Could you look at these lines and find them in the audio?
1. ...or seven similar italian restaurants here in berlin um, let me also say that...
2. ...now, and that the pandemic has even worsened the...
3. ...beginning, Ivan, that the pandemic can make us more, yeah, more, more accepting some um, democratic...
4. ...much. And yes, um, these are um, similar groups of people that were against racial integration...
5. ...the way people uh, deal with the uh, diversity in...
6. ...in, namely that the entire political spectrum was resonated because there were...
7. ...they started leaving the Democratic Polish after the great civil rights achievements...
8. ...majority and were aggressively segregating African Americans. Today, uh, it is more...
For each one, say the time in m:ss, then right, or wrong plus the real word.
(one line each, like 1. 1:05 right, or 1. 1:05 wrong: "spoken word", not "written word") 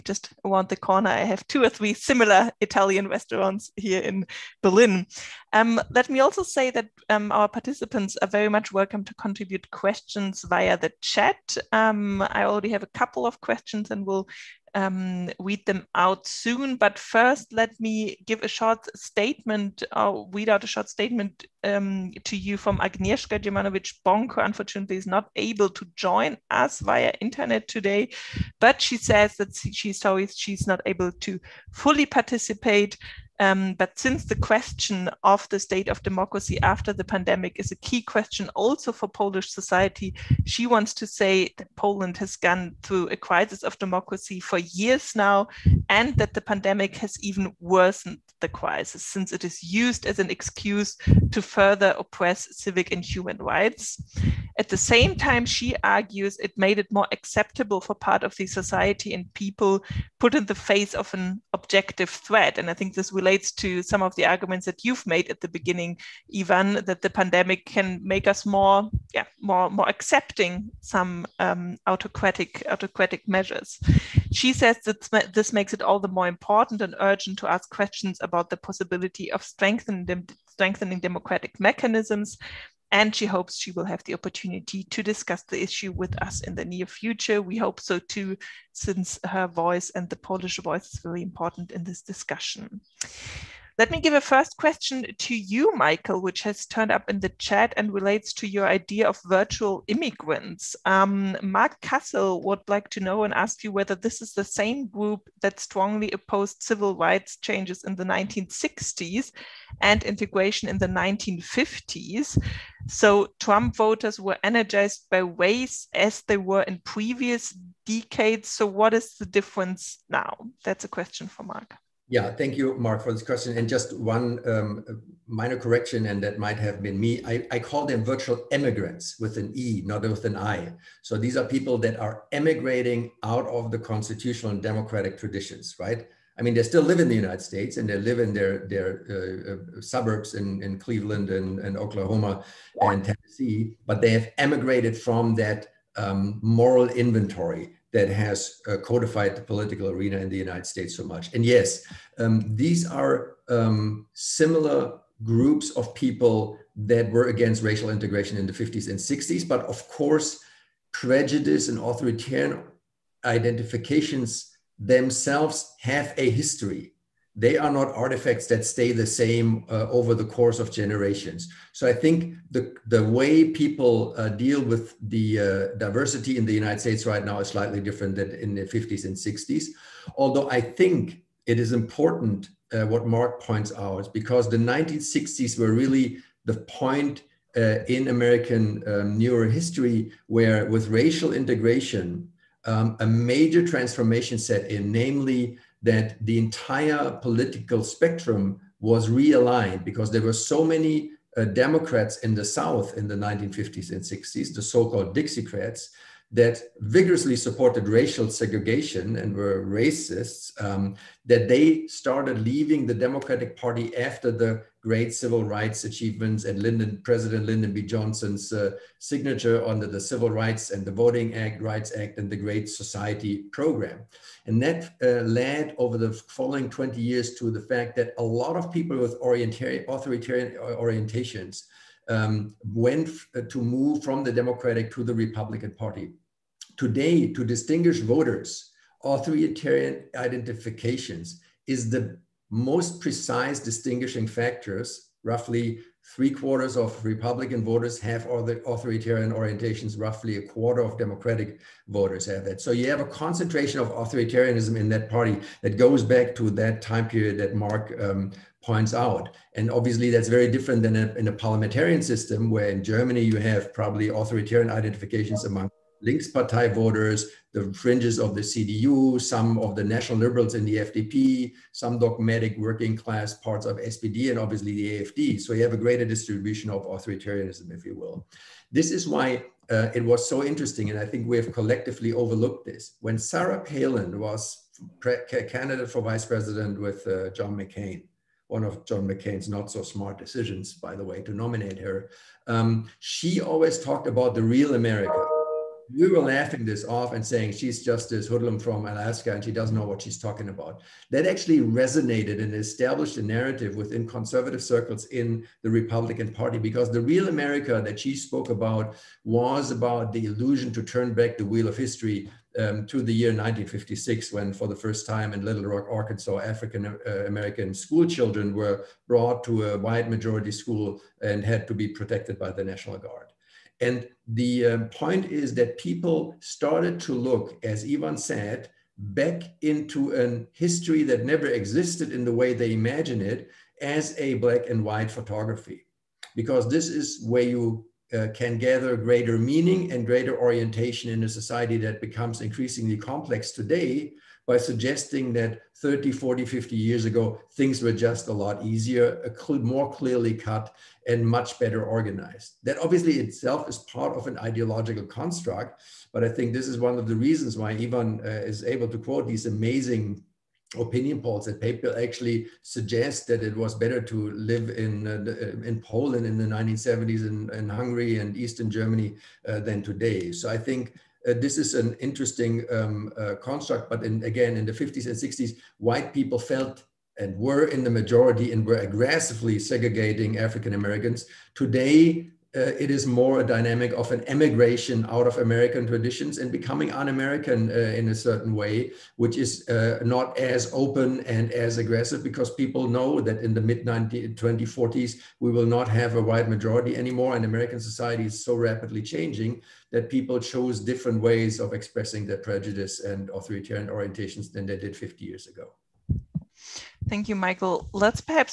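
1. 0:01 wrong: "three", not "seven"
2. 0:45 right
3. 1:05 wrong: "autocratic", not "democratic"
4. 2:31 right
5. 2:52 right
6. 3:14 wrong: "realigned", not "resonated"
7. 3:31 wrong: "Party", not "Polish"
8. 6:17 right.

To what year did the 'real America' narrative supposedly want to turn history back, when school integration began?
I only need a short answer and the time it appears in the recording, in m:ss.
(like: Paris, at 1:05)
1956, at 5:13.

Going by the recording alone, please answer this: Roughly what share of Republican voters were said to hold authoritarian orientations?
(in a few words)
three quarters.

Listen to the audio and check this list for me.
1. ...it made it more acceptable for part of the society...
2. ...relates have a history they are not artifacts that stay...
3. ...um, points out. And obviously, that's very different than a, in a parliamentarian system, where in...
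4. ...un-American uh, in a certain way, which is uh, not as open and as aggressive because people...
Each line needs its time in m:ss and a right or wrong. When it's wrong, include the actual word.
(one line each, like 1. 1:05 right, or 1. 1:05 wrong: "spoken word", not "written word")
1. 0:56 right
2. 2:44 wrong: "themselves", not "relates"
3. 4:17 right
4. 6:26 right.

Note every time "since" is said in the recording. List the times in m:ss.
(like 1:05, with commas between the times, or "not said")
0:33, 0:49, 1:28.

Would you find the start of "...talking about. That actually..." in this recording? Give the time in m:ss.
5:00.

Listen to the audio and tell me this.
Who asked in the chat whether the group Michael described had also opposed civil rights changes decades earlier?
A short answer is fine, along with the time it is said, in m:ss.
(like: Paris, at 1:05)
Mark Castle, at 1:41.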